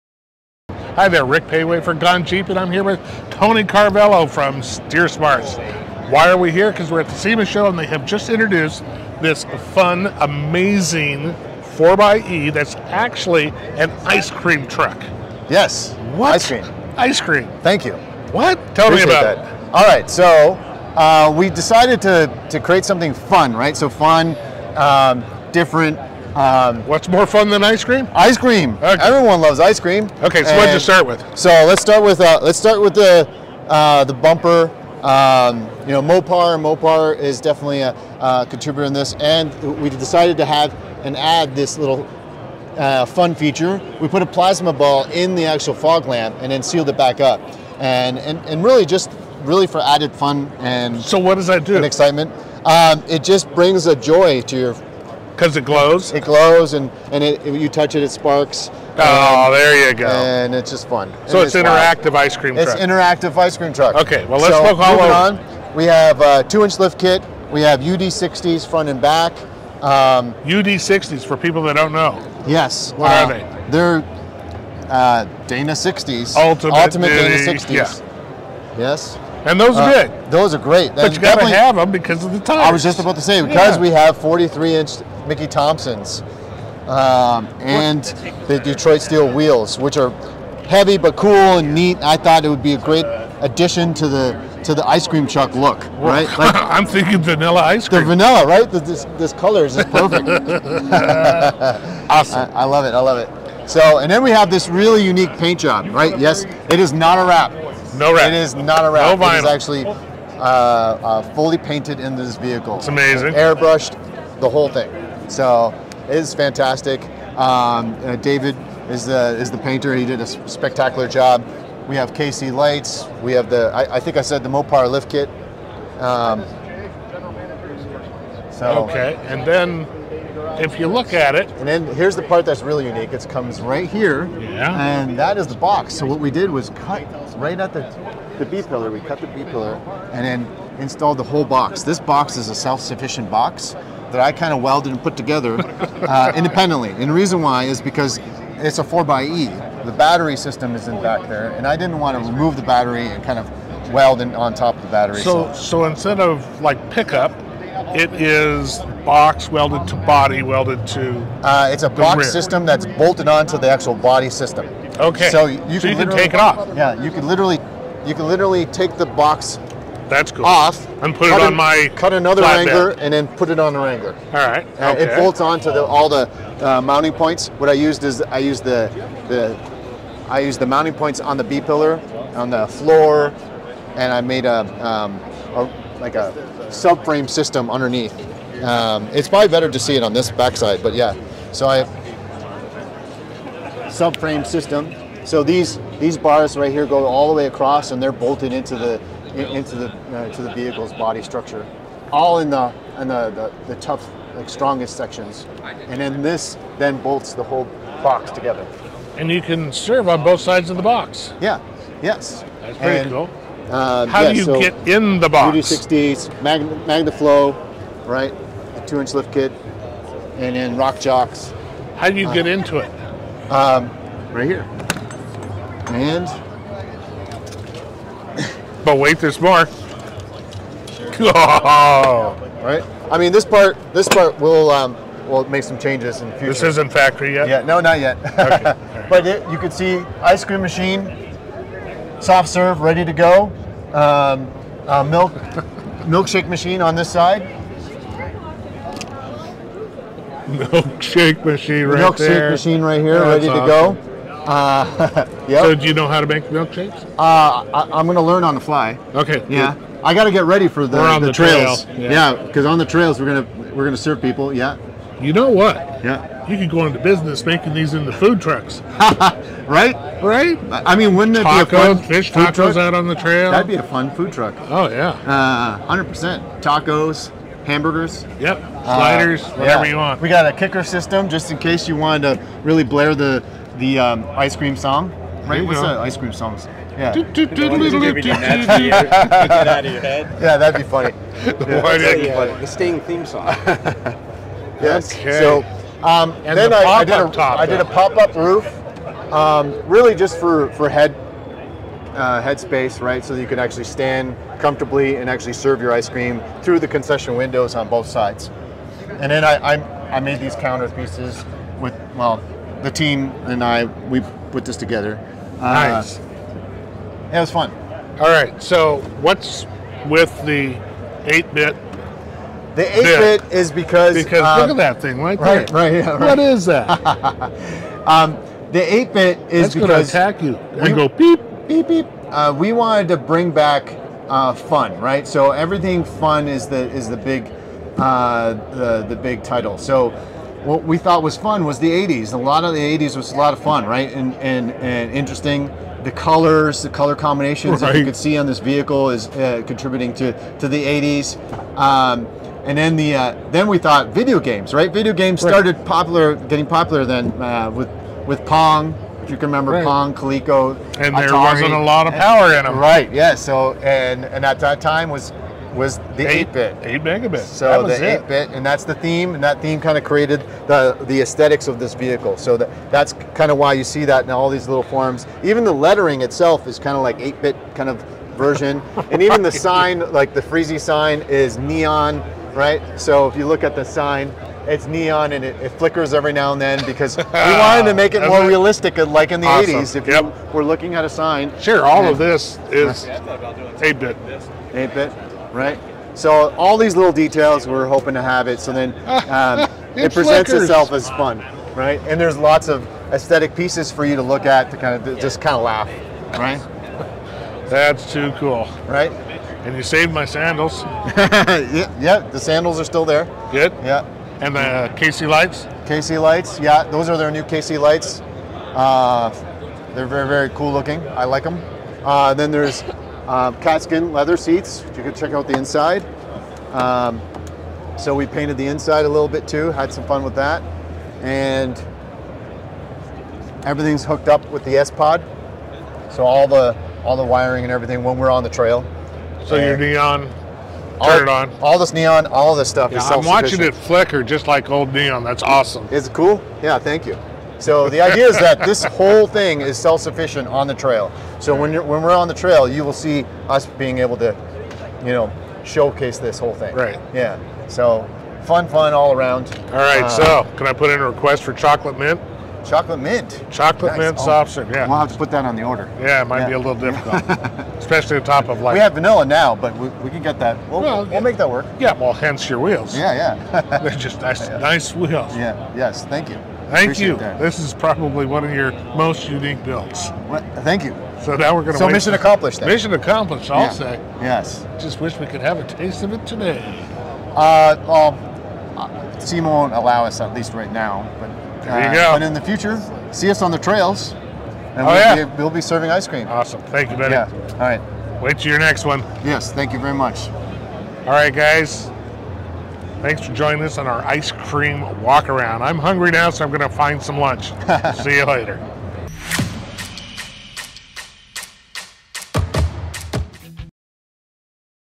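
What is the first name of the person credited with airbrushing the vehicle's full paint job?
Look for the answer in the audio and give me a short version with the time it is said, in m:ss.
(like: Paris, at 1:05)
David, at 1:58.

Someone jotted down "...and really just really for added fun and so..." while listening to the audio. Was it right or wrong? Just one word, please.
right.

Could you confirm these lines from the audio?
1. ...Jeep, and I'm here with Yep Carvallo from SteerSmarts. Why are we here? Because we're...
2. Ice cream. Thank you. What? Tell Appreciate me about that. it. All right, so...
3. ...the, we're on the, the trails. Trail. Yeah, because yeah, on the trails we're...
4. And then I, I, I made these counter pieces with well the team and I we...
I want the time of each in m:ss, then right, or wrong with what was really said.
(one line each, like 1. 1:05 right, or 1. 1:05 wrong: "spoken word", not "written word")
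1. 0:02 wrong: "Tony", not "Yep"
2. 0:16 right
3. 4:20 right
4. 5:09 right.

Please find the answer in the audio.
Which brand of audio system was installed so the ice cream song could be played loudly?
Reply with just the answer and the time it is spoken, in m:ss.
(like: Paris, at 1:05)
Kicker, at 4:40.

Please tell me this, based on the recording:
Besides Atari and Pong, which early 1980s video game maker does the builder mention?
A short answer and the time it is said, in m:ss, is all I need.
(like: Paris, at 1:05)
Coleco, at 6:00.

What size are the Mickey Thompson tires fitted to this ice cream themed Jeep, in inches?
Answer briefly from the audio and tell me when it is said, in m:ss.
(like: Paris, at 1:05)
43, at 1:24.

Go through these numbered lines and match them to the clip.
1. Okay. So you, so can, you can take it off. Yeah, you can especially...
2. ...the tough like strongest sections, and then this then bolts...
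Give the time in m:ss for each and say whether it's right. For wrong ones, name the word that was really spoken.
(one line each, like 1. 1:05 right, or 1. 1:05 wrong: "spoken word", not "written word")
1. 2:44 wrong: "literally", not "especially"
2. 3:23 right.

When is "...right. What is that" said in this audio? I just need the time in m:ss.
5:26.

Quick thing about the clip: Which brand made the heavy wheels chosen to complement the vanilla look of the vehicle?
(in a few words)
Detroit Steel.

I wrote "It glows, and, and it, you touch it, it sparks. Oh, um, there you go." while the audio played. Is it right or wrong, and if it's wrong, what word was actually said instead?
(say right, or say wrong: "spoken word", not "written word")
right.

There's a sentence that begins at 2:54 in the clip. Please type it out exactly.
And It bolts onto the, all the uh, mounting points.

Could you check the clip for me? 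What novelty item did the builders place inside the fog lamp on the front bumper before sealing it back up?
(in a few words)
plasma ball.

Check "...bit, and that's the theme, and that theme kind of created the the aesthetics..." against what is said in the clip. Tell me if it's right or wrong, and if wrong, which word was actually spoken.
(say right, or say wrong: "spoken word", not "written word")
right.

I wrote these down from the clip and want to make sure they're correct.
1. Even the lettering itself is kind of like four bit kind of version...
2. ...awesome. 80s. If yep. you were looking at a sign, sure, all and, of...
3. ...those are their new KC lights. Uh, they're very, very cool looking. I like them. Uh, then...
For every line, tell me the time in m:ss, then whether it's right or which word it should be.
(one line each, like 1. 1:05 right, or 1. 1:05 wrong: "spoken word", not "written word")
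1. 6:15 wrong: "eight", not "four"
2. 6:29 right
3. 6:56 right.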